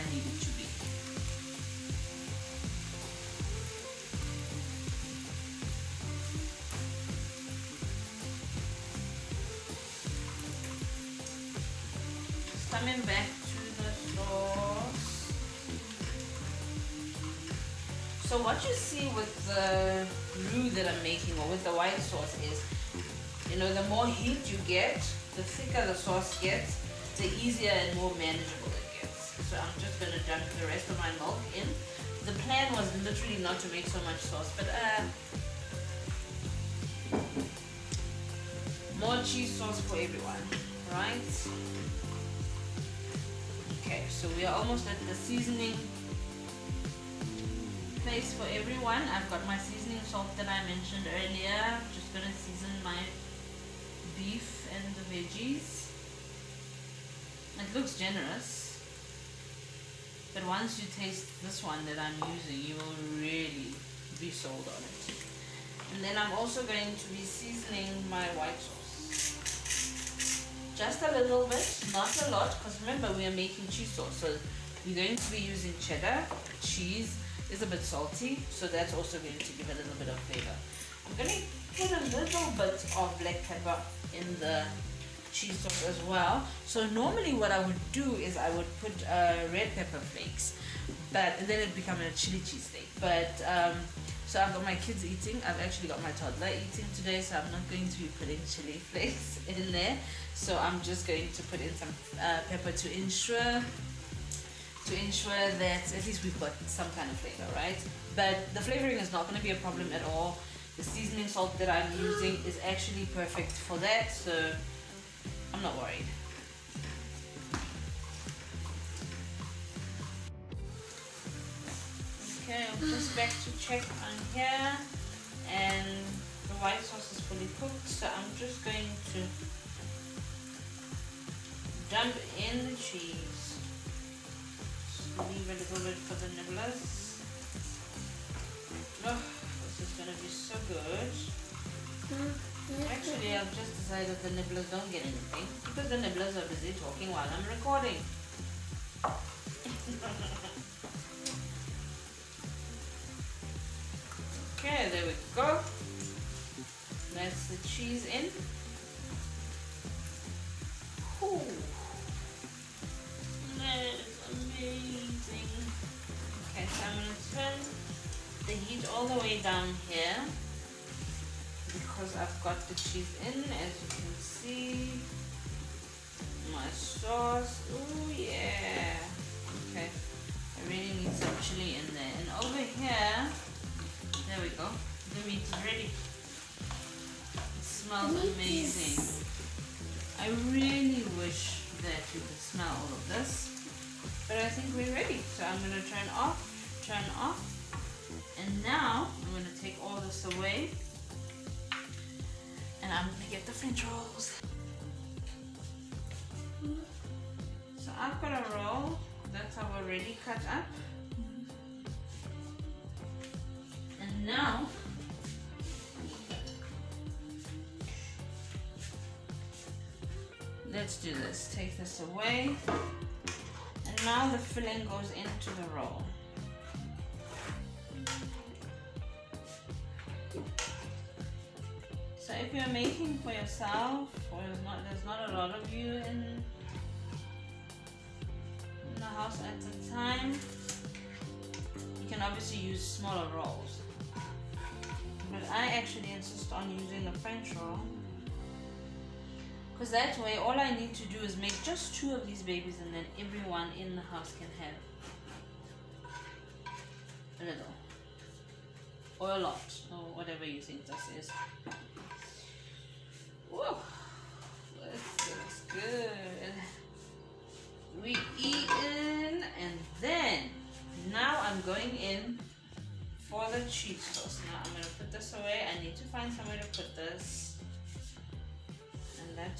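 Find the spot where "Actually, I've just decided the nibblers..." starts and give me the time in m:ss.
2:22.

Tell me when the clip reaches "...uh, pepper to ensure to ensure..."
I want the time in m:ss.
1:42.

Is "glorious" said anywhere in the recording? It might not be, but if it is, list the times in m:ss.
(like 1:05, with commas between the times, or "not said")
not said.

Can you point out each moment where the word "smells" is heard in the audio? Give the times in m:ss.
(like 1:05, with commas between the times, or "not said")
3:07, 3:12.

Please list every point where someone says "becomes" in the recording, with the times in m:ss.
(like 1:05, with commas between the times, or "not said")
1:31.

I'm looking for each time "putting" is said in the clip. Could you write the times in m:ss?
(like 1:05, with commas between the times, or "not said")
1:38.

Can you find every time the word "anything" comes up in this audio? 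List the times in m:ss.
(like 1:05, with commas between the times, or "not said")
2:25.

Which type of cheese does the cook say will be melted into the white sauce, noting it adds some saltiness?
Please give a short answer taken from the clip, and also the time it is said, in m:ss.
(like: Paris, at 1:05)
cheddar, at 1:15.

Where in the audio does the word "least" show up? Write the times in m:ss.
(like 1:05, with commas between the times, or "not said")
1:46.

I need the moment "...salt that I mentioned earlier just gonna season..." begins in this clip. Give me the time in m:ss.
0:50.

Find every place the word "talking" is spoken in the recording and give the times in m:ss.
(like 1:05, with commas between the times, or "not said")
2:26.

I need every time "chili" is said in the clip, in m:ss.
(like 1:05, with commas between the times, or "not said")
1:32, 1:38, 3:01.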